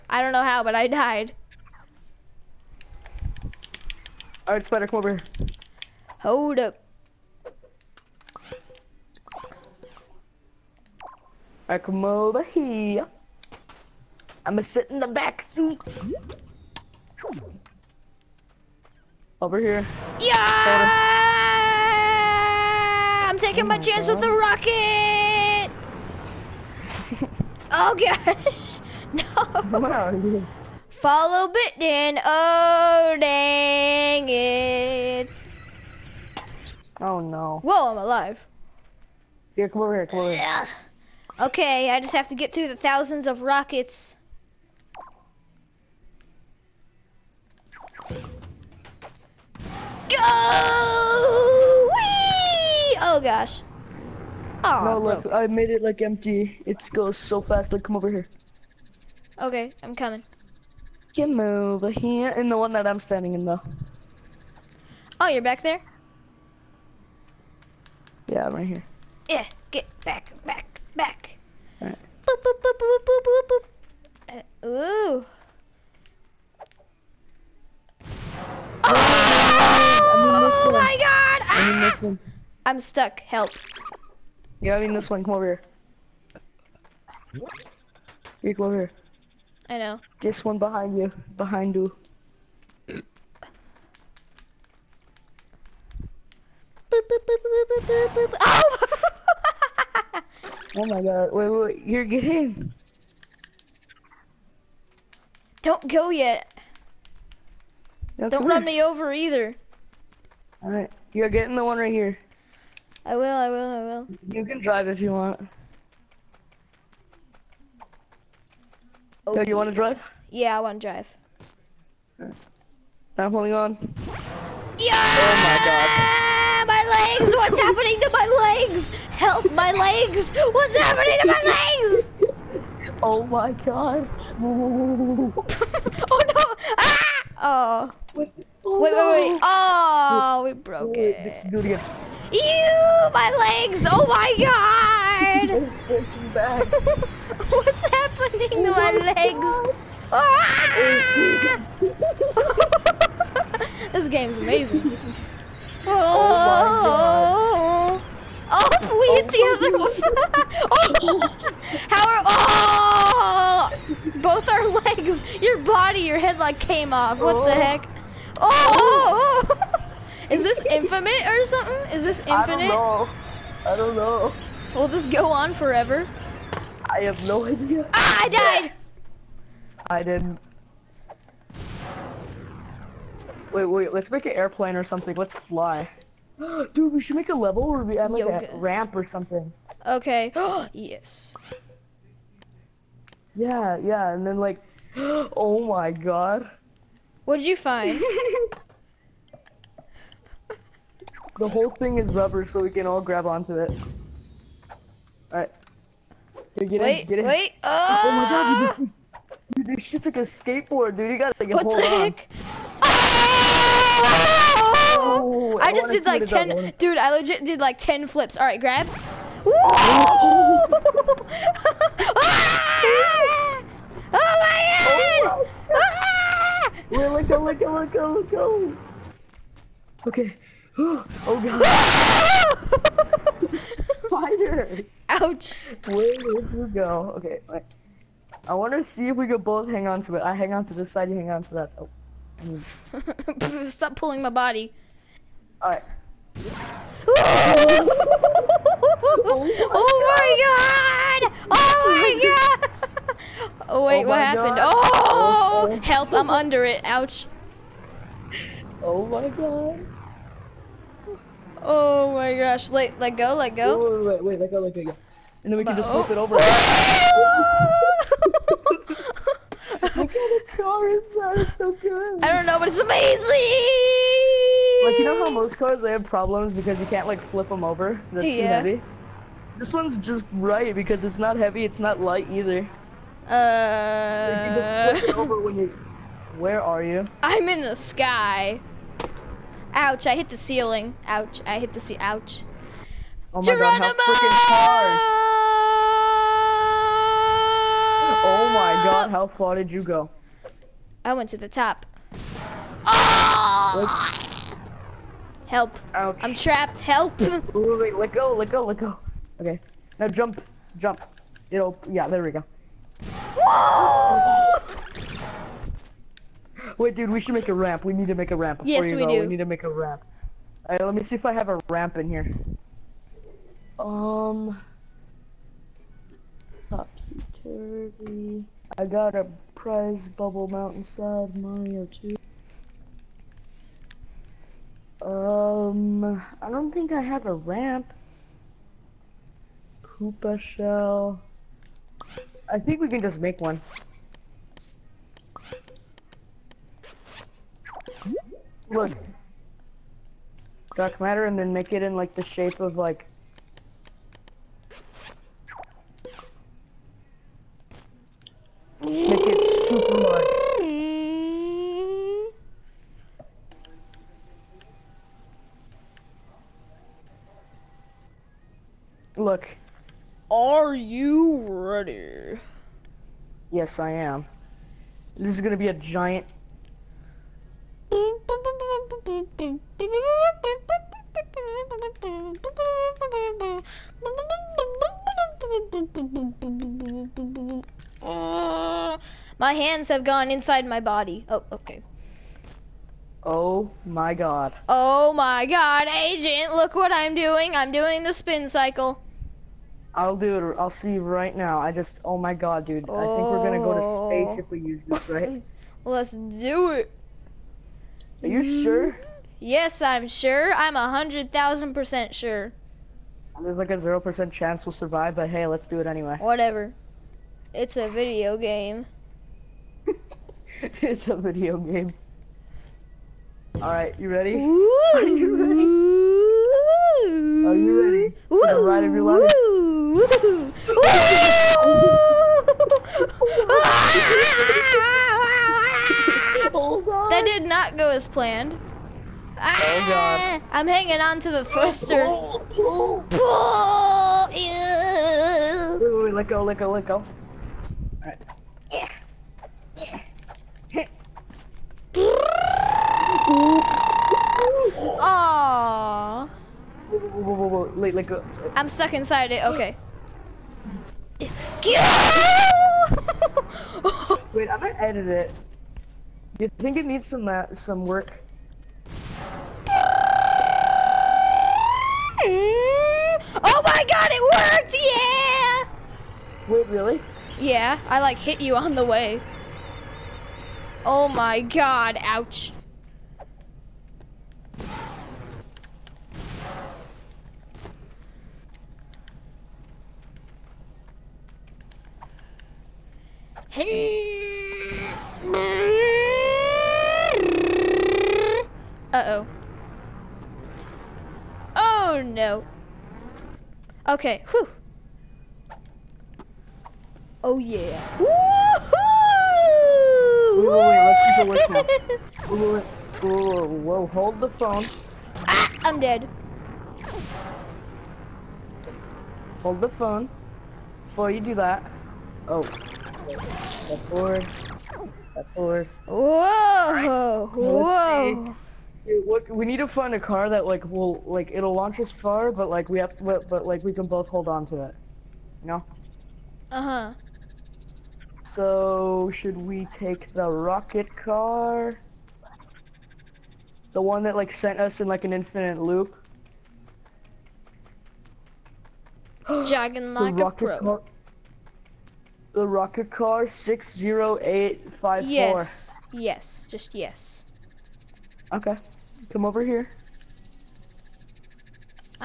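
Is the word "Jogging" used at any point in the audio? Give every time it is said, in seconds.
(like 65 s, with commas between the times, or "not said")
549 s.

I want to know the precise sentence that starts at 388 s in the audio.
Uh, my hands have gone inside my body.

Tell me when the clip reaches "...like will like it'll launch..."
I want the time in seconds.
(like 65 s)
530 s.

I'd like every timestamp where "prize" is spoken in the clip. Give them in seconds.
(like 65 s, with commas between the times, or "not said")
329 s.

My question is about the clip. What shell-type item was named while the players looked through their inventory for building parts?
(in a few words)
Koopa shell.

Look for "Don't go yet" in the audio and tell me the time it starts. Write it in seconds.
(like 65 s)
105 s.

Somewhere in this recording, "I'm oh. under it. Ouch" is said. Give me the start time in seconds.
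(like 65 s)
256 s.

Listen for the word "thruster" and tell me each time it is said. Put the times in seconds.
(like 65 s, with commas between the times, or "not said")
441 s.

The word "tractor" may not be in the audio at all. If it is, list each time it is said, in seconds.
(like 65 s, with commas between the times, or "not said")
not said.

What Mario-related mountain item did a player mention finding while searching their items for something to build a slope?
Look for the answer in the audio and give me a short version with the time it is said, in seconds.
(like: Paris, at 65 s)
Bubble Mountainside Mario 2, at 330 s.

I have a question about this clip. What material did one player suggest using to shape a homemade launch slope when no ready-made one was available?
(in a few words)
Dark matter.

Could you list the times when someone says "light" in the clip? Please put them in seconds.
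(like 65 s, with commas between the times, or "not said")
282 s.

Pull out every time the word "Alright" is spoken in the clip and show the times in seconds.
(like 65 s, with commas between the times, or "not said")
71 s, 110 s, 205 s, 218 s, 245 s, 320 s.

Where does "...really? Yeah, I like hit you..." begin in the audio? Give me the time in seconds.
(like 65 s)
476 s.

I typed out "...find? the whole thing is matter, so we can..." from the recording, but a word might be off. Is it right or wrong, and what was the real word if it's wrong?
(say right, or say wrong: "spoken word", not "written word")
wrong: "rubber", not "matter".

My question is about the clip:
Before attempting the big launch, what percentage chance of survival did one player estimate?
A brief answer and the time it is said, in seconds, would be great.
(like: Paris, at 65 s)
0 percent, at 413 s.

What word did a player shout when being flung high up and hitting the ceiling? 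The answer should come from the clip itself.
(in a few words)
Geronimo.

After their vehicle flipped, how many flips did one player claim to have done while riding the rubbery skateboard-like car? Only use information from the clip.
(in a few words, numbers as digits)
10.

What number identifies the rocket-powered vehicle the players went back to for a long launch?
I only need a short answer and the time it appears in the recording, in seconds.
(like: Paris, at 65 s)
60854, at 553 s.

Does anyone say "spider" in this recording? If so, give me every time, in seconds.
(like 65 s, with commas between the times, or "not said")
4 s, 233 s.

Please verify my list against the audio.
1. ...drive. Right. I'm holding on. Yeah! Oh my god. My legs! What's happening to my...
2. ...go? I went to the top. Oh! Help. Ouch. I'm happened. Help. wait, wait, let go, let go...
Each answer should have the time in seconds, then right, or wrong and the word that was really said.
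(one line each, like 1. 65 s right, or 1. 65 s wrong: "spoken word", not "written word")
1. 120 s right
2. 299 s wrong: "trapped", not "happened".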